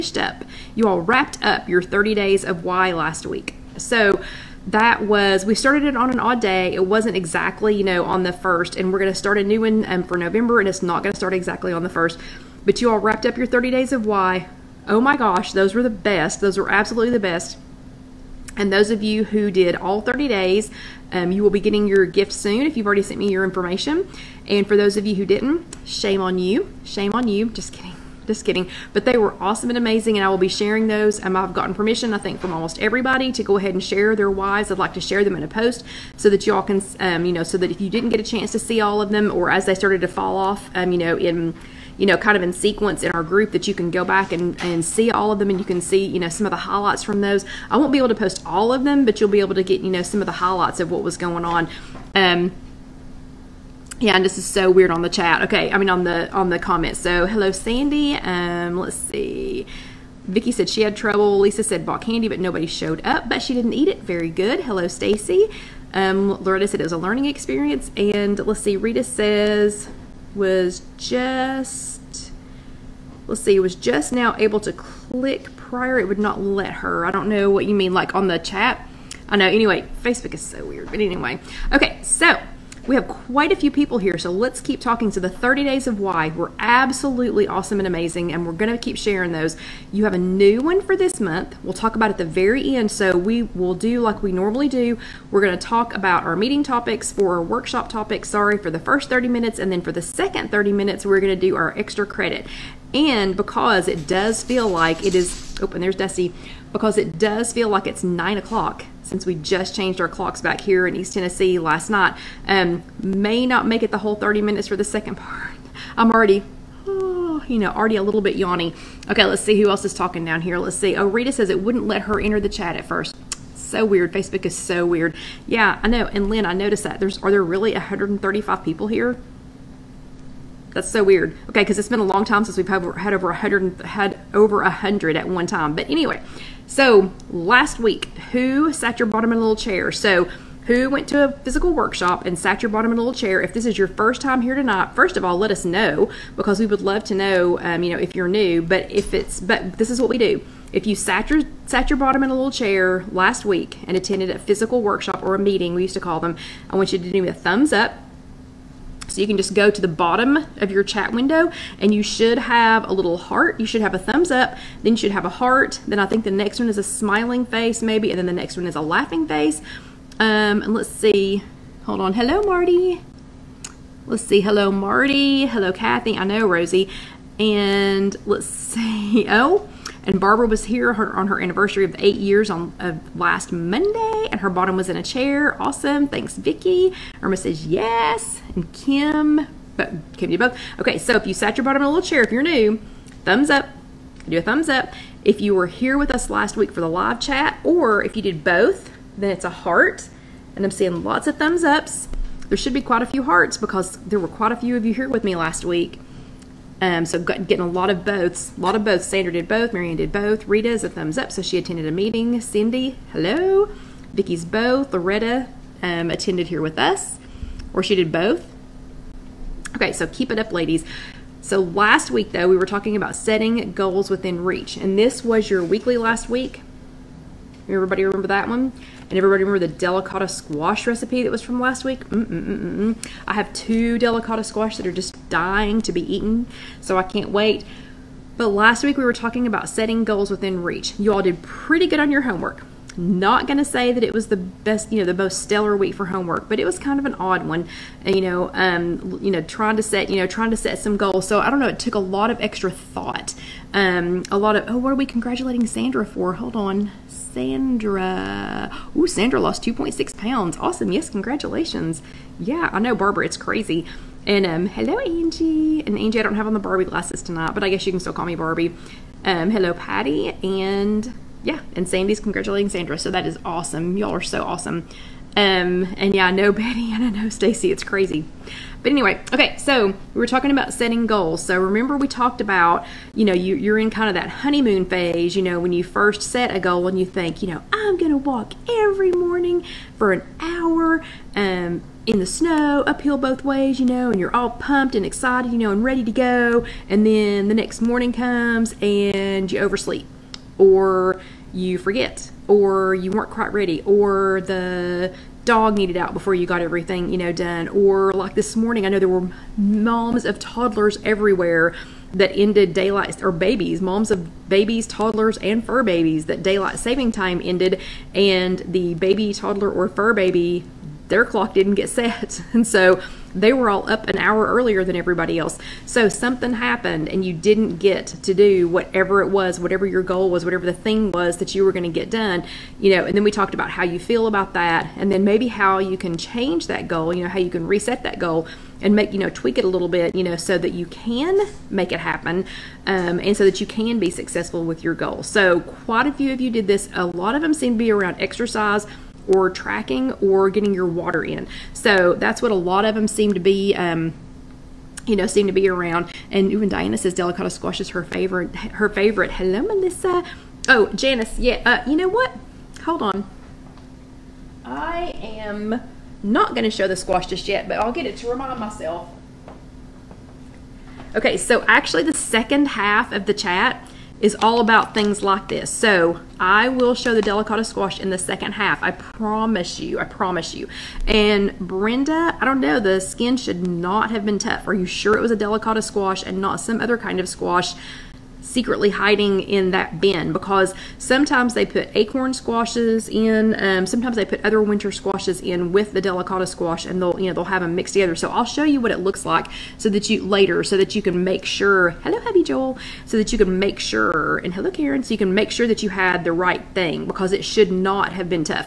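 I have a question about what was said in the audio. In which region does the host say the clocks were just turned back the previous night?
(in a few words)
East Tennessee.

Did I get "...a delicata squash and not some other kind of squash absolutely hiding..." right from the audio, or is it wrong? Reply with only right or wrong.
wrong.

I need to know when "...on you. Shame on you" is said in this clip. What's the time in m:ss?
0:26.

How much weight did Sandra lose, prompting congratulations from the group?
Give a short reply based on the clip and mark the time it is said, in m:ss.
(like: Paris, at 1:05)
2.6 pounds, at 4:19.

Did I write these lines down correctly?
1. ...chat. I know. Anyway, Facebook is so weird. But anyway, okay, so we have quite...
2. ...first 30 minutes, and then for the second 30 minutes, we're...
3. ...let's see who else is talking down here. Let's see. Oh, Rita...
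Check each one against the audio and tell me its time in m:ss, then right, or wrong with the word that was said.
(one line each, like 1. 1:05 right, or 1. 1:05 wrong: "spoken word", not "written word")
1. 1:18 right
2. 1:38 right
3. 1:59 right.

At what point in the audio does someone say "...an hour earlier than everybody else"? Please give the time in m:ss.
5:24.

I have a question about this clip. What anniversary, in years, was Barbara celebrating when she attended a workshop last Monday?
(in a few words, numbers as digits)
8.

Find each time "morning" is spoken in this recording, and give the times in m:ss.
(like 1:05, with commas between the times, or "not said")
4:49, 4:57, 5:08.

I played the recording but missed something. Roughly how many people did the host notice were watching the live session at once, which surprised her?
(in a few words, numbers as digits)
135.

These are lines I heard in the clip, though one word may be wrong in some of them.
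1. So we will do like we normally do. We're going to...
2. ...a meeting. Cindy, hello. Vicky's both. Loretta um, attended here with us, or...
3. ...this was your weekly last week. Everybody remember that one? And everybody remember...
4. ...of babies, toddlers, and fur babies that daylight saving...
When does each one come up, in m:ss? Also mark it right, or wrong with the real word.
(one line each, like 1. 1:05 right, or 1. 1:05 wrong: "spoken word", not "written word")
1. 1:32 right
2. 3:31 right
3. 3:44 right
4. 5:14 right.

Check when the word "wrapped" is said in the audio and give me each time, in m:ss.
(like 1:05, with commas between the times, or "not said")
0:01, 0:12.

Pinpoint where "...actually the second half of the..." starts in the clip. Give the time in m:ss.
6:11.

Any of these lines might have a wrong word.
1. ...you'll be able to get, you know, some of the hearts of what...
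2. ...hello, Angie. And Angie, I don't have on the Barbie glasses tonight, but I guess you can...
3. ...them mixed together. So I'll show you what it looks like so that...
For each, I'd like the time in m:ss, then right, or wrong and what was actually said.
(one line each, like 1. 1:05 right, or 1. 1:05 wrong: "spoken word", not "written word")
1. 0:49 wrong: "highlights", not "hearts"
2. 4:24 right
3. 6:37 right.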